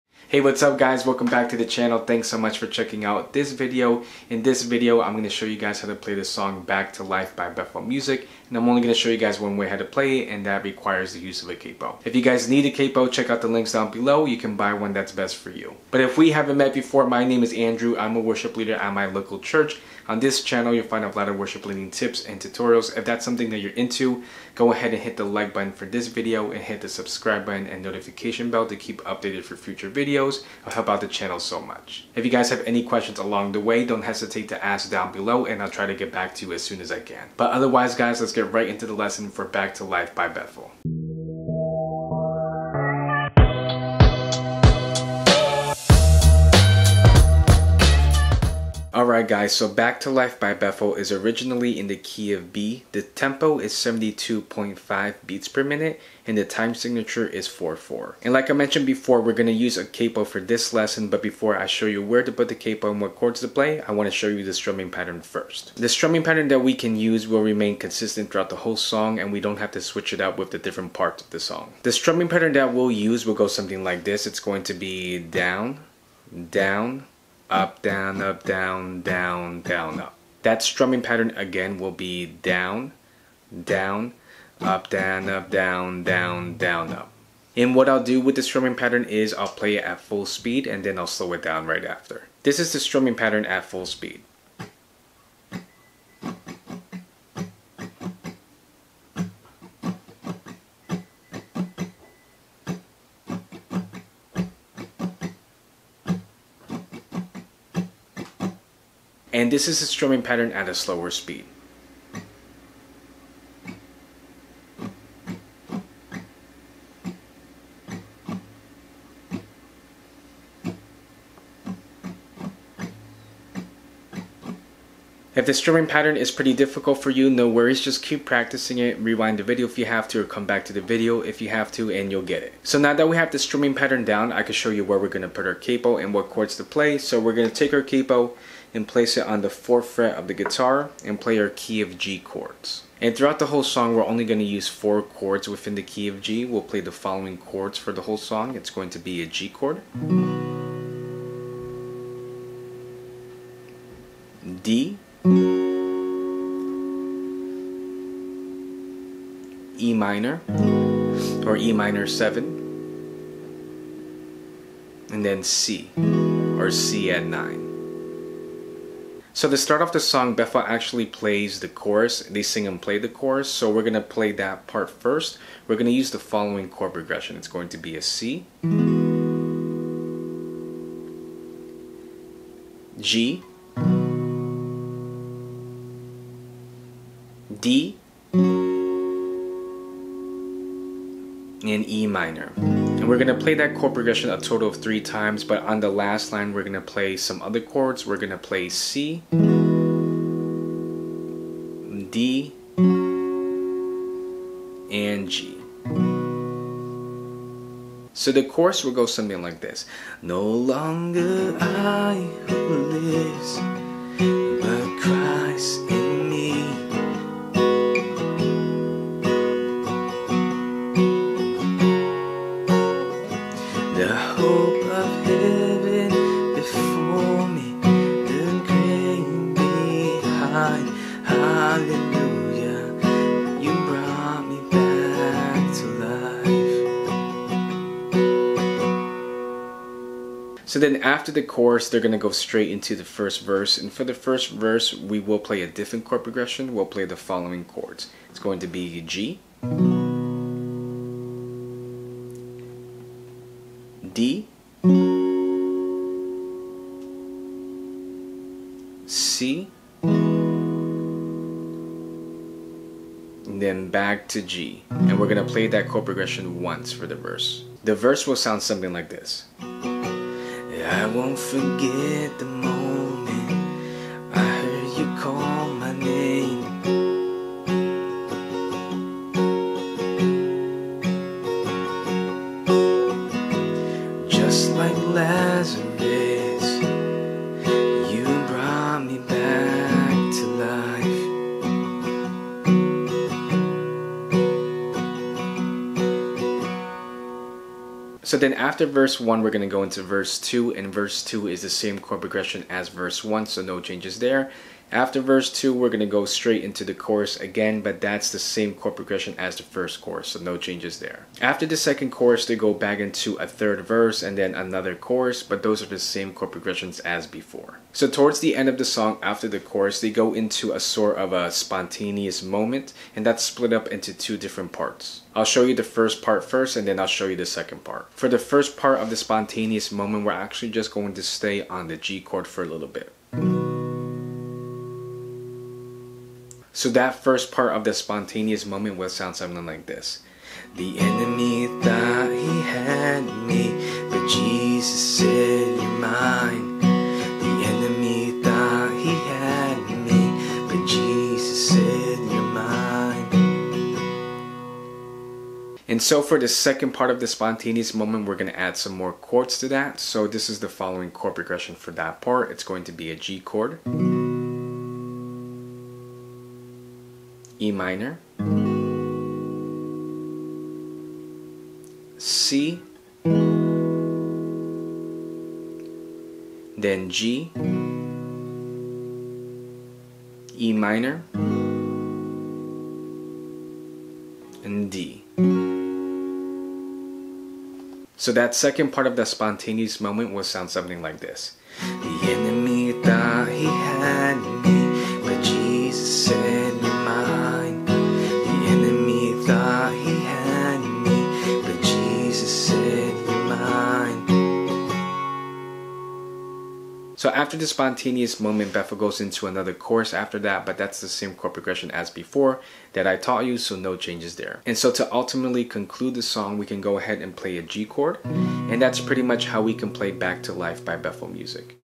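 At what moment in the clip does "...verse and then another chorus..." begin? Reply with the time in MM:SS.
05:13.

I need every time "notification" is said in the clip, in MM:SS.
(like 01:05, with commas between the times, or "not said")
00:27.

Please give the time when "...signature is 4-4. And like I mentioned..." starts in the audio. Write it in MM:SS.
00:56.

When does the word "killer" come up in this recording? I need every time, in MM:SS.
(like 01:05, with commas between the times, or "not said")
not said.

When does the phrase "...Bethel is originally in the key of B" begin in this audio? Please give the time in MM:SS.
00:50.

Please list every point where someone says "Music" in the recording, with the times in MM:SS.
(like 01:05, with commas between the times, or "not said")
00:07, 07:01.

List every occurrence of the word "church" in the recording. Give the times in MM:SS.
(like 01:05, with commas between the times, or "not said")
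00:19.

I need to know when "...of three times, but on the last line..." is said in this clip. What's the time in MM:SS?
03:14.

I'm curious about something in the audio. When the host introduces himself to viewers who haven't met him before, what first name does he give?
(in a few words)
Andrew.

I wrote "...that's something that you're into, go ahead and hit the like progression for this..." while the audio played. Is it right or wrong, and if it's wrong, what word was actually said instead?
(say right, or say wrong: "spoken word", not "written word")
wrong: "button", not "progression".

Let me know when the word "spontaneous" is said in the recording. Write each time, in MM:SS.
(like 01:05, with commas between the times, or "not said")
05:21, 05:29, 05:37, 05:57, 06:29, 06:47.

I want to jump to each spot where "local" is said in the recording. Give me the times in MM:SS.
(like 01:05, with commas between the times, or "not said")
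00:19.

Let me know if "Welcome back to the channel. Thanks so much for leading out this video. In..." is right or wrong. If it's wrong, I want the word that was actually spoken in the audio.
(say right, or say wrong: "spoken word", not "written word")
wrong: "checking", not "leading".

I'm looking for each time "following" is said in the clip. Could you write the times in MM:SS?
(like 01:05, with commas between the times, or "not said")
02:26, 02:56, 04:07, 06:00.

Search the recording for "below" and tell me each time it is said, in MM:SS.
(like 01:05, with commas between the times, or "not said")
00:13, 00:35.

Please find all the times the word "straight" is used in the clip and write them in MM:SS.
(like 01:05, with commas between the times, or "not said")
04:02, 05:06.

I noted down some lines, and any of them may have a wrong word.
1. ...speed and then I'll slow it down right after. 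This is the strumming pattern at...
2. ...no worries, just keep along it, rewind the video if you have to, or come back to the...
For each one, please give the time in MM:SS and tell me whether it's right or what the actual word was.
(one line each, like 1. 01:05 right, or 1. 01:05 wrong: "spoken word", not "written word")
1. 01:30 right
2. 02:07 wrong: "practicing", not "along".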